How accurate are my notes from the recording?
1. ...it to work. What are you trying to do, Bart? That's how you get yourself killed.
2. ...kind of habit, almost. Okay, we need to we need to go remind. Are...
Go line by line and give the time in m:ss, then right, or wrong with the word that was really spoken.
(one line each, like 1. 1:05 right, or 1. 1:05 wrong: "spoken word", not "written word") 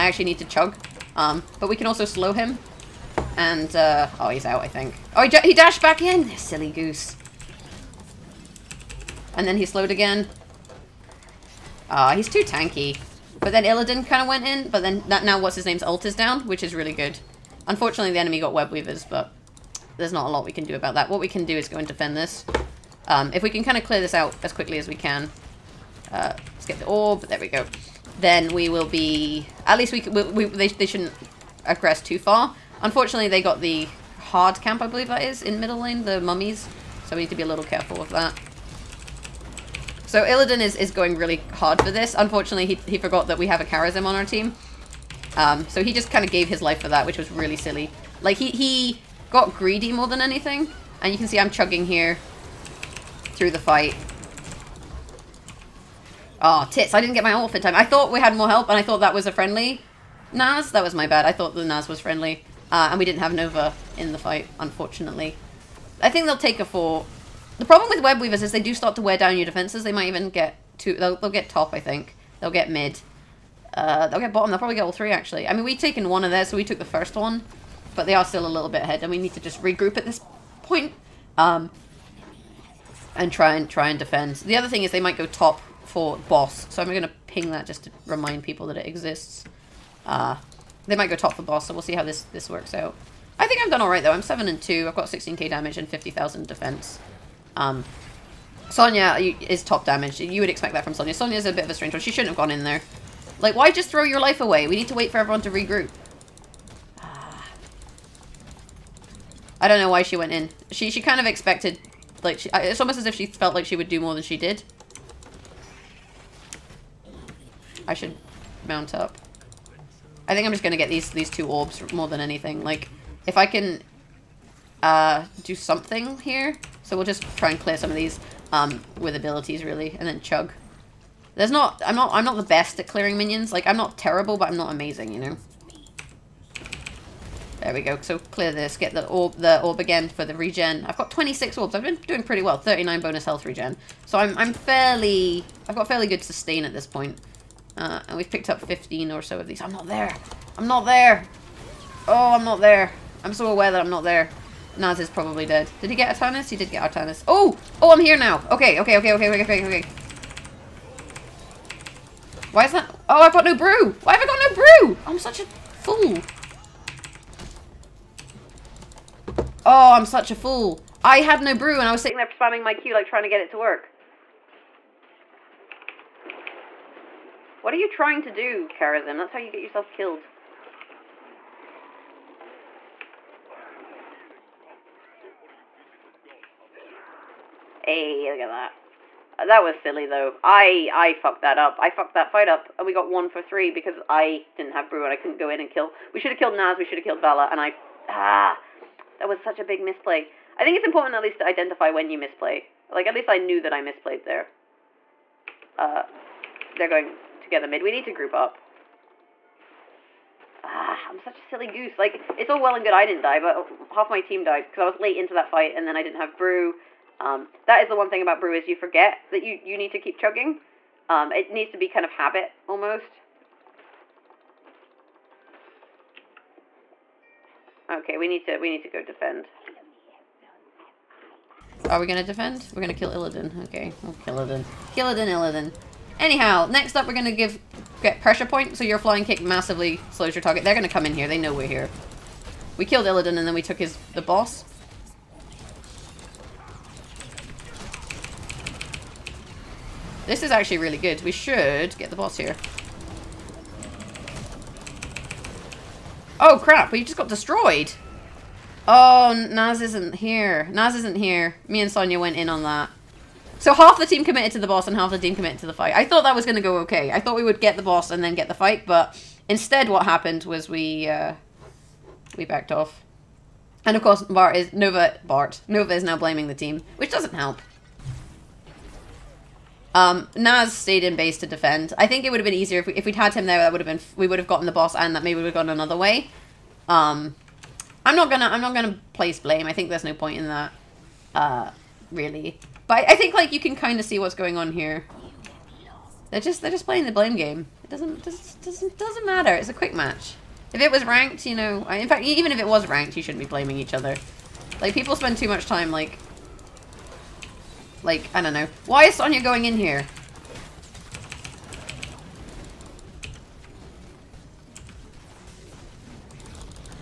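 1. 2:53 wrong: "Kharazim", not "Bart"
2. 3:41 wrong: "defend", not "remind".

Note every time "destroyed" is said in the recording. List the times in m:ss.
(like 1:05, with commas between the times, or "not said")
4:17.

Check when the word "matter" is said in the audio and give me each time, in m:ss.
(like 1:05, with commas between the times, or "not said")
4:59.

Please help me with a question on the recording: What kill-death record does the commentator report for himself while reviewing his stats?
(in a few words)
7 and 2.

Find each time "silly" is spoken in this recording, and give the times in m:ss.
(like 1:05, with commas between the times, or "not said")
0:06, 0:47, 3:09, 3:31.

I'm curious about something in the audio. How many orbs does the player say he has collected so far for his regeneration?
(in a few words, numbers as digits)
26.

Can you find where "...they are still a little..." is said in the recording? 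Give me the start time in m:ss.
1:18.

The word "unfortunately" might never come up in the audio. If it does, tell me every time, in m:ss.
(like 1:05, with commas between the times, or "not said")
0:17, 0:32, 0:42, 1:04.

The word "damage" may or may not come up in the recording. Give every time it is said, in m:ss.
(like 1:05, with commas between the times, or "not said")
1:35, 1:39.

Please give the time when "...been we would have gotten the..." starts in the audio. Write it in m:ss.
4:43.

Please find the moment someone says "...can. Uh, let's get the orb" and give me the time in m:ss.
0:24.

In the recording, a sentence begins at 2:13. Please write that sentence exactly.
Like, I'm not terrible, but I'm not amazing, you know?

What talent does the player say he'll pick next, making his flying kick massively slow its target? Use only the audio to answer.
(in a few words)
Pressure Point.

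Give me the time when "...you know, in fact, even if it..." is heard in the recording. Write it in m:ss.
5:01.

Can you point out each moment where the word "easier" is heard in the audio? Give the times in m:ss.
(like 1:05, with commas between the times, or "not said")
4:42.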